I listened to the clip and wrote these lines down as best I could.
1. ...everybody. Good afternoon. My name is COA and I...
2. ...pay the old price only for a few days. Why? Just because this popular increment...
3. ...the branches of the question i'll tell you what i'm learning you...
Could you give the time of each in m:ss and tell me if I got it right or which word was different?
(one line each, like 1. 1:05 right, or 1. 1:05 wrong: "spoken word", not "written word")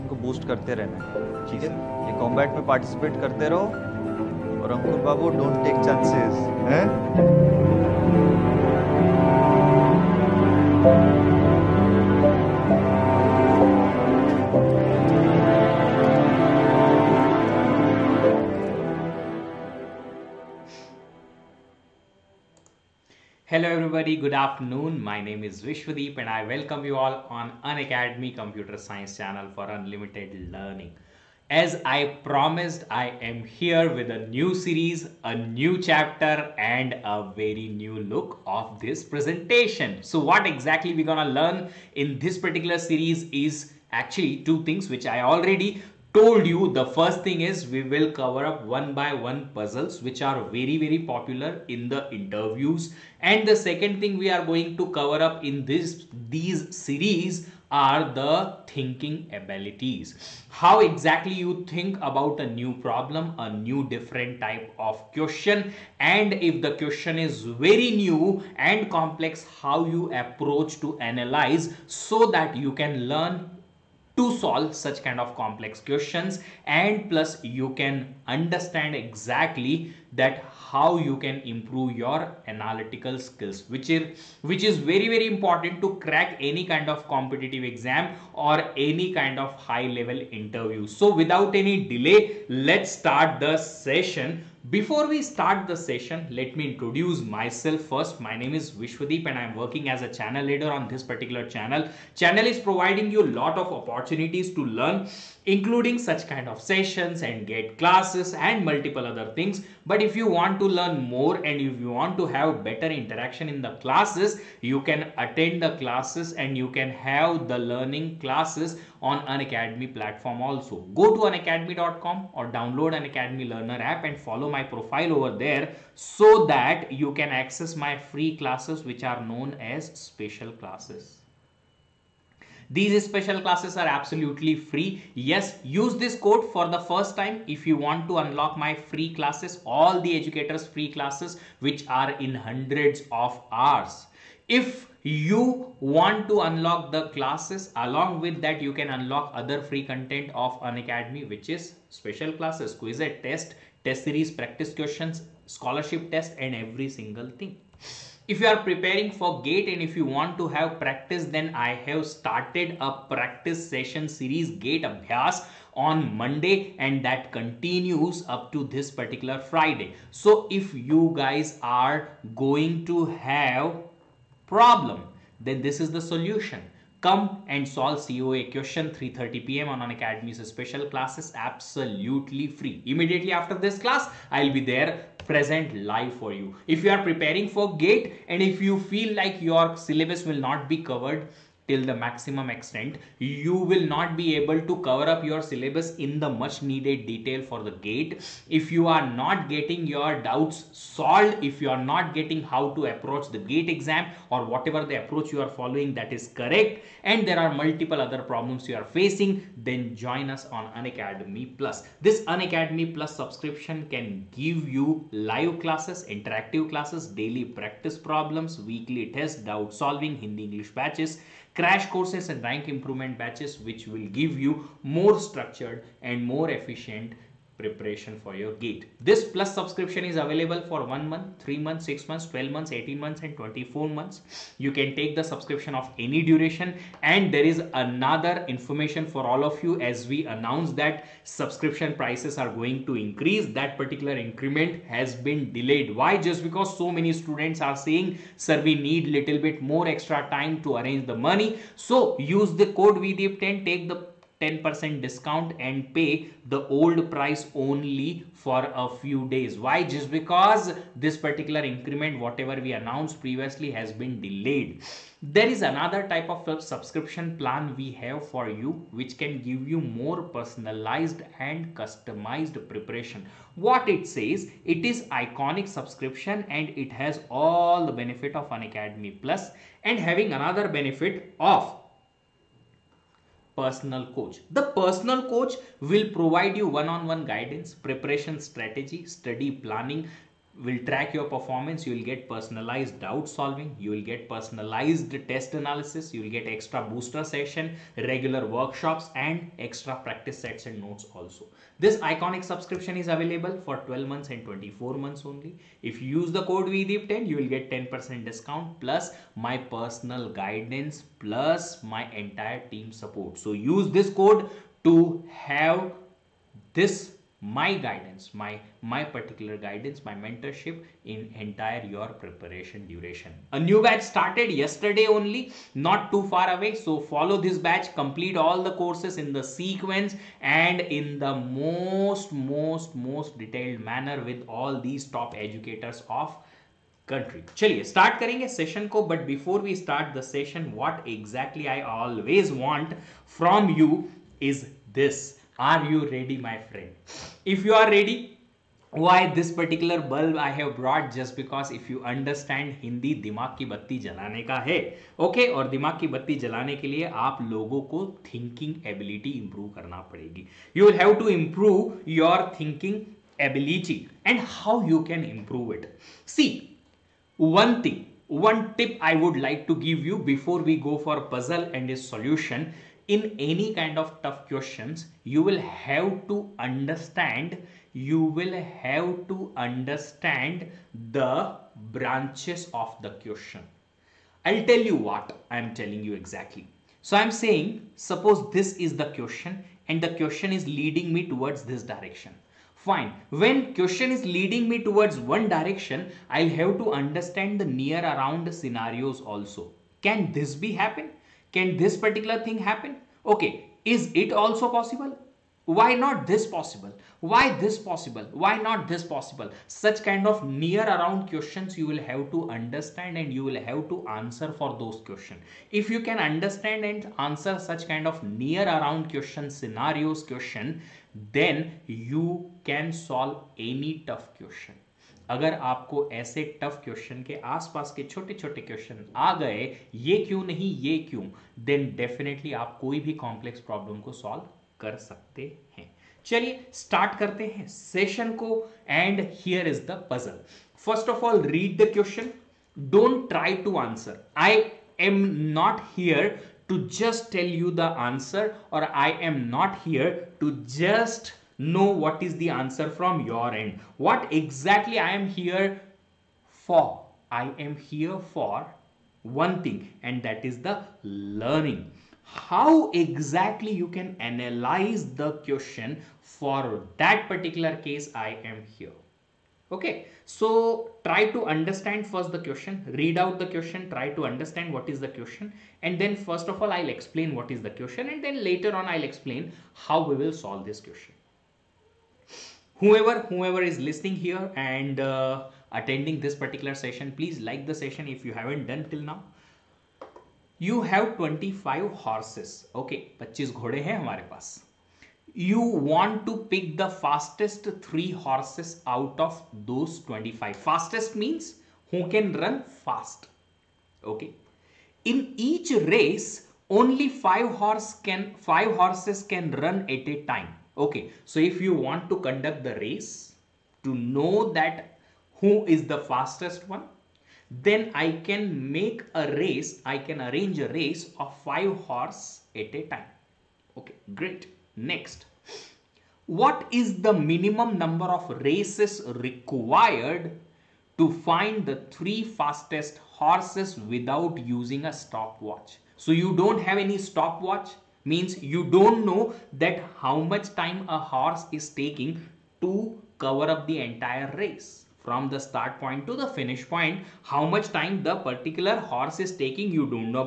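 1. 0:24 wrong: "Vishwadeep", not "COA"
2. 4:15 wrong: "particular", not "popular"
3. 6:21 wrong: "telling", not "learning".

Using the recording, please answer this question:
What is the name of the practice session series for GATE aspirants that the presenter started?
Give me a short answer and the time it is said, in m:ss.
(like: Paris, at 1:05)
gate abhyas, at 2:44.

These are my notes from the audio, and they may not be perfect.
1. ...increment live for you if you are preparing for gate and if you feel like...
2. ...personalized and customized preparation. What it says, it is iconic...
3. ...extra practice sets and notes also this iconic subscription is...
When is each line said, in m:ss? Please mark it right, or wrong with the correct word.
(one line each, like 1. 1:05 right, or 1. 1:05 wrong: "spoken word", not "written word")
1. 3:05 wrong: "present", not "increment"
2. 4:30 right
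3. 4:59 right.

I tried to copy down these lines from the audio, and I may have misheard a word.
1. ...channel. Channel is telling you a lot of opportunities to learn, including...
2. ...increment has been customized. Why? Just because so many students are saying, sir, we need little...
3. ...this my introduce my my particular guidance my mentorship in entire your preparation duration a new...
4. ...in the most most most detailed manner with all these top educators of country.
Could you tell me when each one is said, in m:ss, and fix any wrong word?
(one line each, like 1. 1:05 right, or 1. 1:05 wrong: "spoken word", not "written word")
1. 1:41 wrong: "providing", not "telling"
2. 4:04 wrong: "delayed", not "customized"
3. 5:16 wrong: "guidance", not "introduce"
4. 5:30 right.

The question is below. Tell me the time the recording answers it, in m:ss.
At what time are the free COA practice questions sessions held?
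2:58.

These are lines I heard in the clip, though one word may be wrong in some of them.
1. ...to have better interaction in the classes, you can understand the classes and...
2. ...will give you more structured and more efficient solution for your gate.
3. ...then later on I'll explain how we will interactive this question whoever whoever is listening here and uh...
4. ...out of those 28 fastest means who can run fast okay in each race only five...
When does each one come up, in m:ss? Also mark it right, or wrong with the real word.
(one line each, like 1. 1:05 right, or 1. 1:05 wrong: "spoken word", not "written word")
1. 1:52 wrong: "attend", not "understand"
2. 3:43 wrong: "preparation", not "solution"
3. 7:58 wrong: "solve", not "interactive"
4. 8:18 wrong: "25", not "28".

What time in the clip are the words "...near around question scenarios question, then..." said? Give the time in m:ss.
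6:58.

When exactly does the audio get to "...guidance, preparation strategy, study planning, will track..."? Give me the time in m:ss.
4:47.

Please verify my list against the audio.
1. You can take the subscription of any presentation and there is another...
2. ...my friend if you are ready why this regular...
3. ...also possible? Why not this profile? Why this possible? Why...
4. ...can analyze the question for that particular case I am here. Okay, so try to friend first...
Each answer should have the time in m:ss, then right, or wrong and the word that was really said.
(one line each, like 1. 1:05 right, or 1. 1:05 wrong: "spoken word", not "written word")
1. 3:54 wrong: "duration", not "presentation"
2. 5:46 wrong: "particular", not "regular"
3. 6:44 wrong: "possible", not "profile"
4. 7:43 wrong: "understand", not "friend".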